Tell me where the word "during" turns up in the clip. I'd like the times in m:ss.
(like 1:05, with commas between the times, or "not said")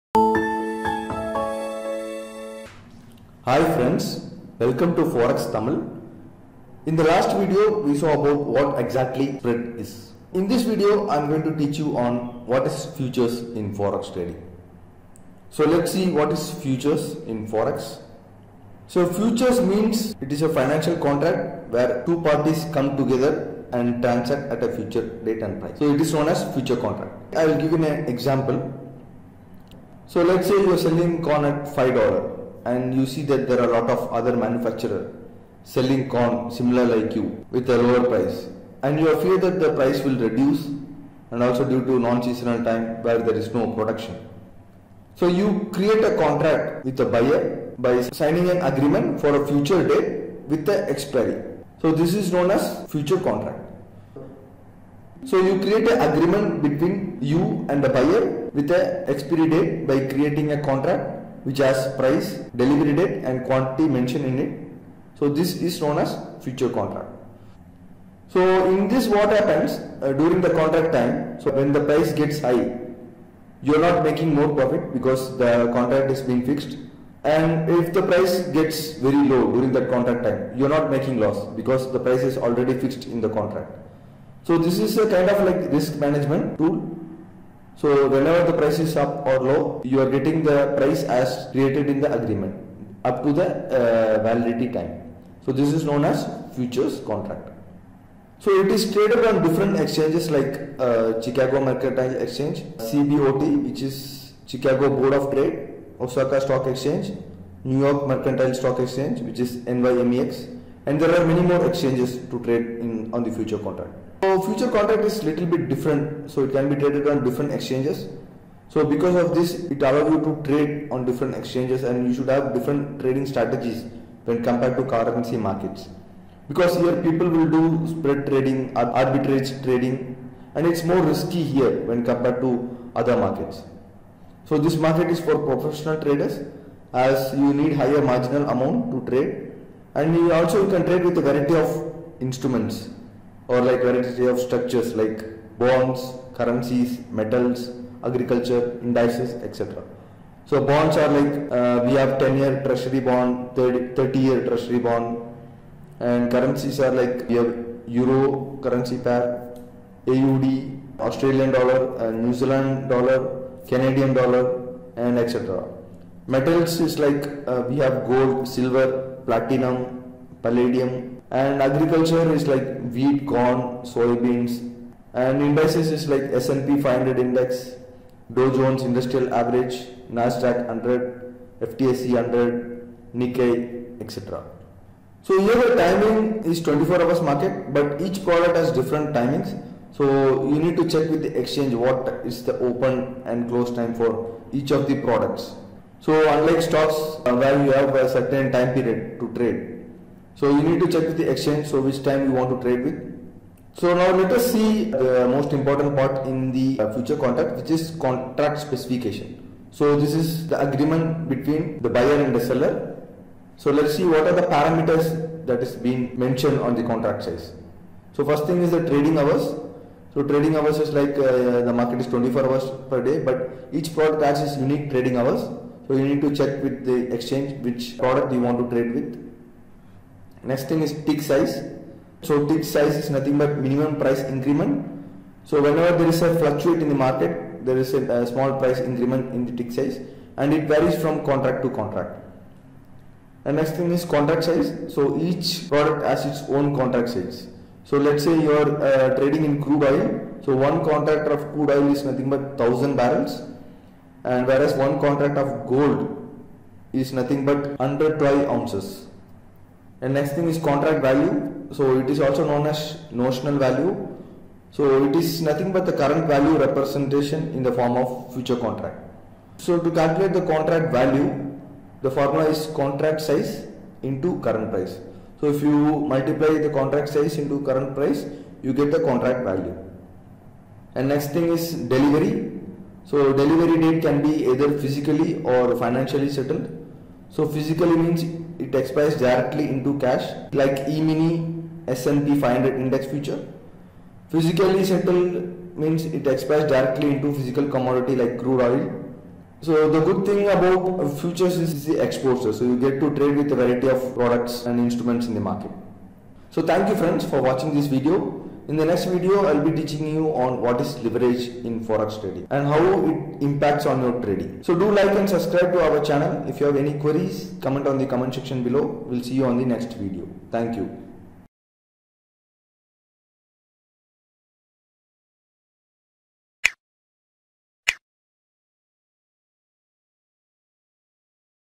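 1:10, 1:19.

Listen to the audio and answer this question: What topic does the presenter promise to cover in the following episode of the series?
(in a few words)
Leverage.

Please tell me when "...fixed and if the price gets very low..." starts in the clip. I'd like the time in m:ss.
1:16.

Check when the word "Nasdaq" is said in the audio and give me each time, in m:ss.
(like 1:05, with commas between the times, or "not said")
3:00.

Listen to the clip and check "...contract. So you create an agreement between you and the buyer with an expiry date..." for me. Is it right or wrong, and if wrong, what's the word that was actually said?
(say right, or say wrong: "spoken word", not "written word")
right.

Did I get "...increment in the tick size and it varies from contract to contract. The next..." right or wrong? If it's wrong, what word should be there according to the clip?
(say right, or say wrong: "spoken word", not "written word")
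right.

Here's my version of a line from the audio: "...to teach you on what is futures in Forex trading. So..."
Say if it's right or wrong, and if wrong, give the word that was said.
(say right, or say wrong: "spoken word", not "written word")
right.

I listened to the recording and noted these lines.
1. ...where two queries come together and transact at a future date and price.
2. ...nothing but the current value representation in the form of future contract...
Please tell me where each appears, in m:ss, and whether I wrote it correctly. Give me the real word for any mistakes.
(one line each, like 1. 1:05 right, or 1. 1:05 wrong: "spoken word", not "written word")
1. 0:21 wrong: "parties", not "queries"
2. 4:25 right.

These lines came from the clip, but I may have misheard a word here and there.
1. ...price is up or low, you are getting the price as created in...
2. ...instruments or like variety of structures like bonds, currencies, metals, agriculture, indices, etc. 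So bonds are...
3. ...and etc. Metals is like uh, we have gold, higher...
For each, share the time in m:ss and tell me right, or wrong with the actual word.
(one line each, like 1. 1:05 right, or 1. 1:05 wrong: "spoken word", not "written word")
1. 1:28 right
2. 2:22 right
3. 2:44 wrong: "silver", not "higher".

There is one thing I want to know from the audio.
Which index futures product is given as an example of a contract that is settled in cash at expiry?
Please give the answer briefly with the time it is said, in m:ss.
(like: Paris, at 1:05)
E-mini S&P 500, at 4:50.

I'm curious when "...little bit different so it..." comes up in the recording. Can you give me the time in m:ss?
1:55.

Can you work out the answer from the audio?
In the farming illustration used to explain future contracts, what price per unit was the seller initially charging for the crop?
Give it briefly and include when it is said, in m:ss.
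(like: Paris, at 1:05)
$5, at 0:31.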